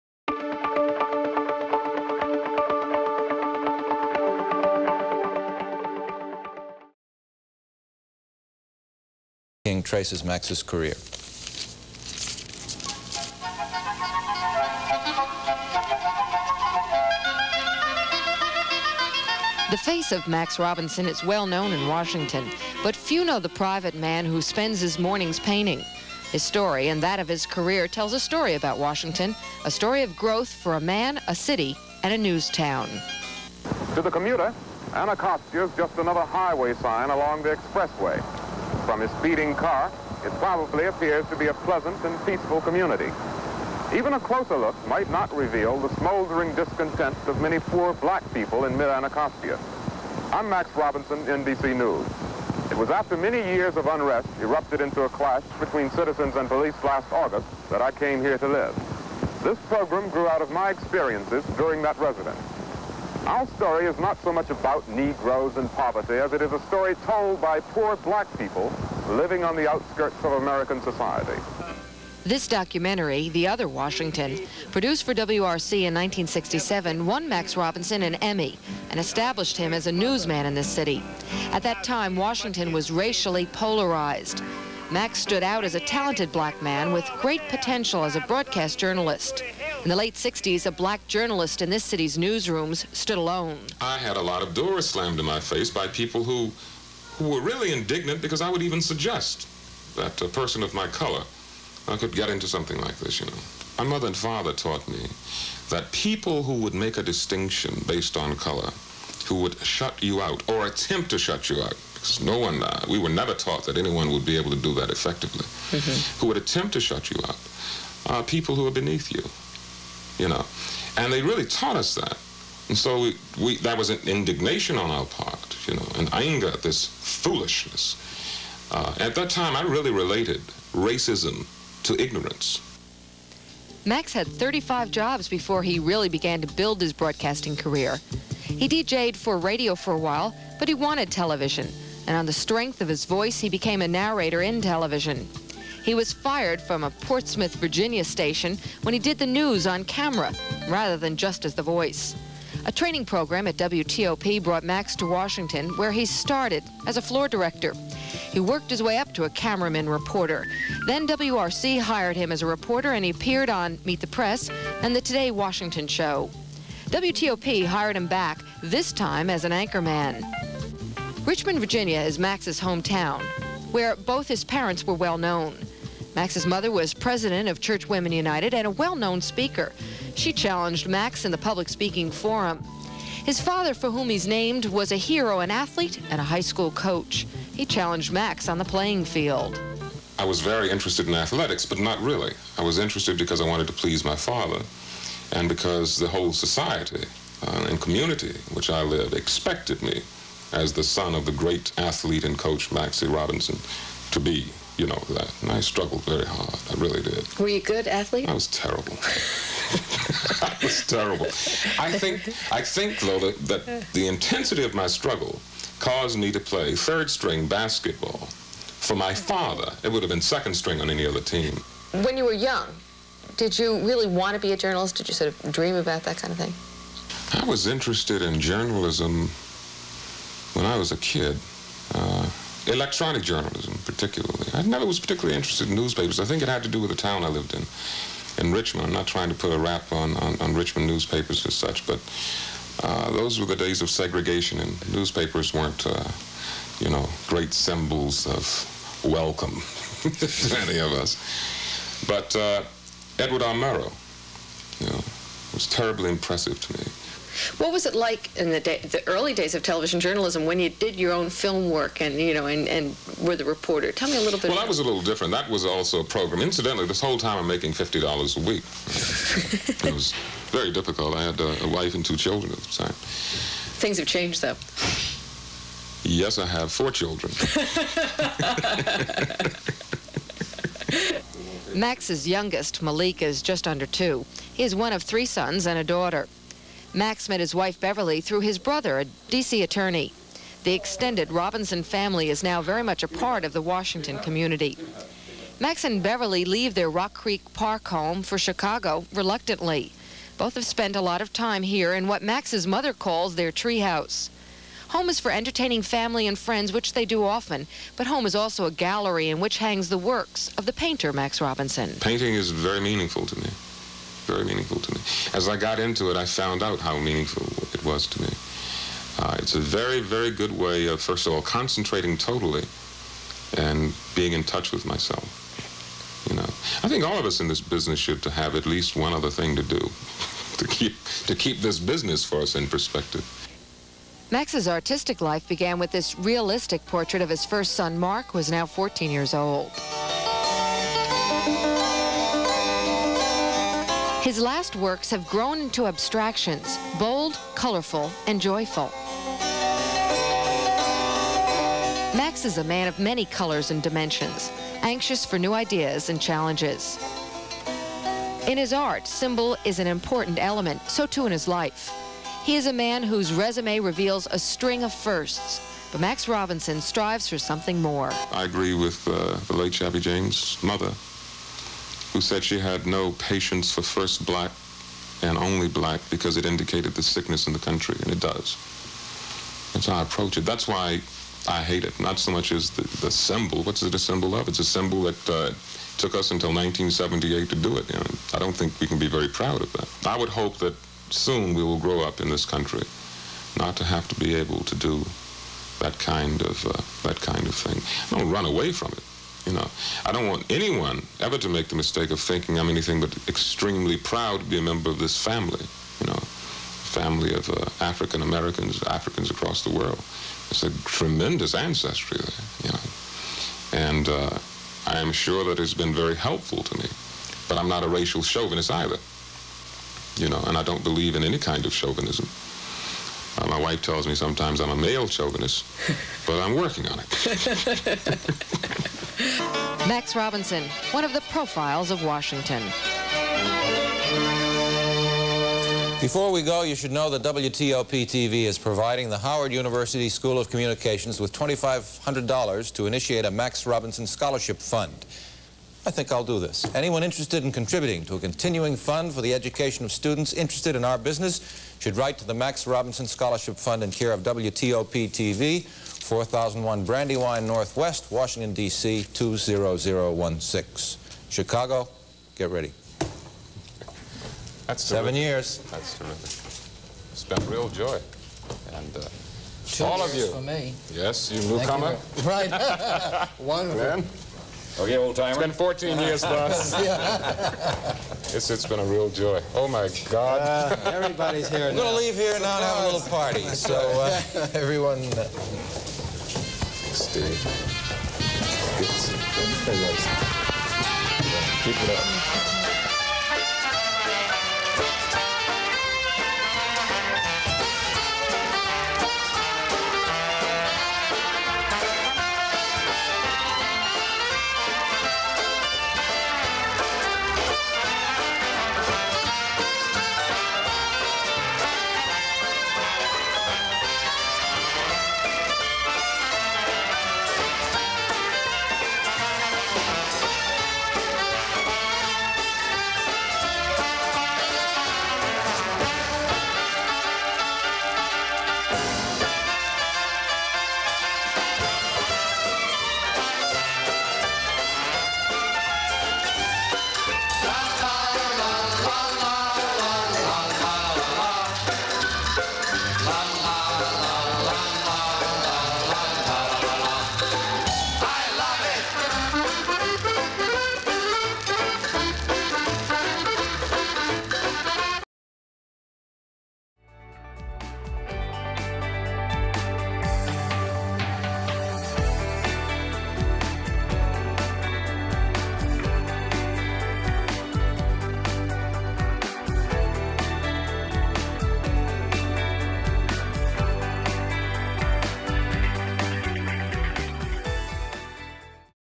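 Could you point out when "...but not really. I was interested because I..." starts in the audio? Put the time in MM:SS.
03:11.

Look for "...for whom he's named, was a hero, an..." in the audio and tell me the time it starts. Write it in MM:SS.
03:03.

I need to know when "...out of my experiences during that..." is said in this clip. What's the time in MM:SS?
01:00.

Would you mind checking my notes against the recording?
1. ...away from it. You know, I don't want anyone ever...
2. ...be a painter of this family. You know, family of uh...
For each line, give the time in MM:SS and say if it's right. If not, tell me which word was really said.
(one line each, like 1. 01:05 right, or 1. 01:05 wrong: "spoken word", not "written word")
1. 06:38 right
2. 06:44 wrong: "member", not "painter".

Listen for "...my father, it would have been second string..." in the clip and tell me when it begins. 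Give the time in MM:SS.
03:38.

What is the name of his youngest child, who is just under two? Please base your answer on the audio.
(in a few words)
Malik.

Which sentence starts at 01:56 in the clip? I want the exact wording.
who would attempt to shut you out, are people who are beneath you you know.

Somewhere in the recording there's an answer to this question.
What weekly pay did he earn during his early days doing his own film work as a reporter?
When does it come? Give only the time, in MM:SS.
04:27.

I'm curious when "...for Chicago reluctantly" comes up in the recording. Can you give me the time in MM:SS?
04:58.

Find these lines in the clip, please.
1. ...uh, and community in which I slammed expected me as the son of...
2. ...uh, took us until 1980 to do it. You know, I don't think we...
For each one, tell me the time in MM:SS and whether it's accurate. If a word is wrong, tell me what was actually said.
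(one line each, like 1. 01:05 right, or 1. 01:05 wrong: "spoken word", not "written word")
1. 03:17 wrong: "lived", not "slammed"
2. 06:25 wrong: "1978", not "1980".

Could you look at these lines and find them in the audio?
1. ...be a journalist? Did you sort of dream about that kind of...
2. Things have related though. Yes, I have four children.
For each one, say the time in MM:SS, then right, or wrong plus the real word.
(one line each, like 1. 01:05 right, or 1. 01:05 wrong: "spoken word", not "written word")
1. 03:44 right
2. 04:32 wrong: "changed", not "related".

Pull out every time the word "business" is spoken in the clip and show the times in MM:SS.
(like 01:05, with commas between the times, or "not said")
05:27, 05:31, 07:30.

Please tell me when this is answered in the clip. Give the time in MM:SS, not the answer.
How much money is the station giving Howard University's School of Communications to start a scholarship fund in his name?
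07:21.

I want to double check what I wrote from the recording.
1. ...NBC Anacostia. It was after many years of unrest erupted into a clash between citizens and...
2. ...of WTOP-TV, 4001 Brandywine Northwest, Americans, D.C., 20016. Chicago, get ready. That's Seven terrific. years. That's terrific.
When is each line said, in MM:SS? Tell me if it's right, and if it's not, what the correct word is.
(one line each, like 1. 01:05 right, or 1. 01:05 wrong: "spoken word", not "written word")
1. 00:51 wrong: "News", not "Anacostia"
2. 07:34 wrong: "Washington", not "Americans".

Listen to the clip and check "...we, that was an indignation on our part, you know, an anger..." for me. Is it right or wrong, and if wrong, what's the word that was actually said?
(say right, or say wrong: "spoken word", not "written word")
right.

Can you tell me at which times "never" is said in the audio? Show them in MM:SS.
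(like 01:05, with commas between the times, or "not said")
01:53, 03:54.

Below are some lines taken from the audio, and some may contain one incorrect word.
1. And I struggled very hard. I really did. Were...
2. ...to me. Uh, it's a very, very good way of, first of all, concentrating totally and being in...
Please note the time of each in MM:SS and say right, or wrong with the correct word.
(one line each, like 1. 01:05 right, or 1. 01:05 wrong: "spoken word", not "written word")
1. 03:25 right
2. 05:18 right.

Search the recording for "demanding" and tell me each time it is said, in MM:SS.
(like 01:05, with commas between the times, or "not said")
not said.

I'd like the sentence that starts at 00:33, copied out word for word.
To the commuter, Anacostia is just another highway sign along the expressway.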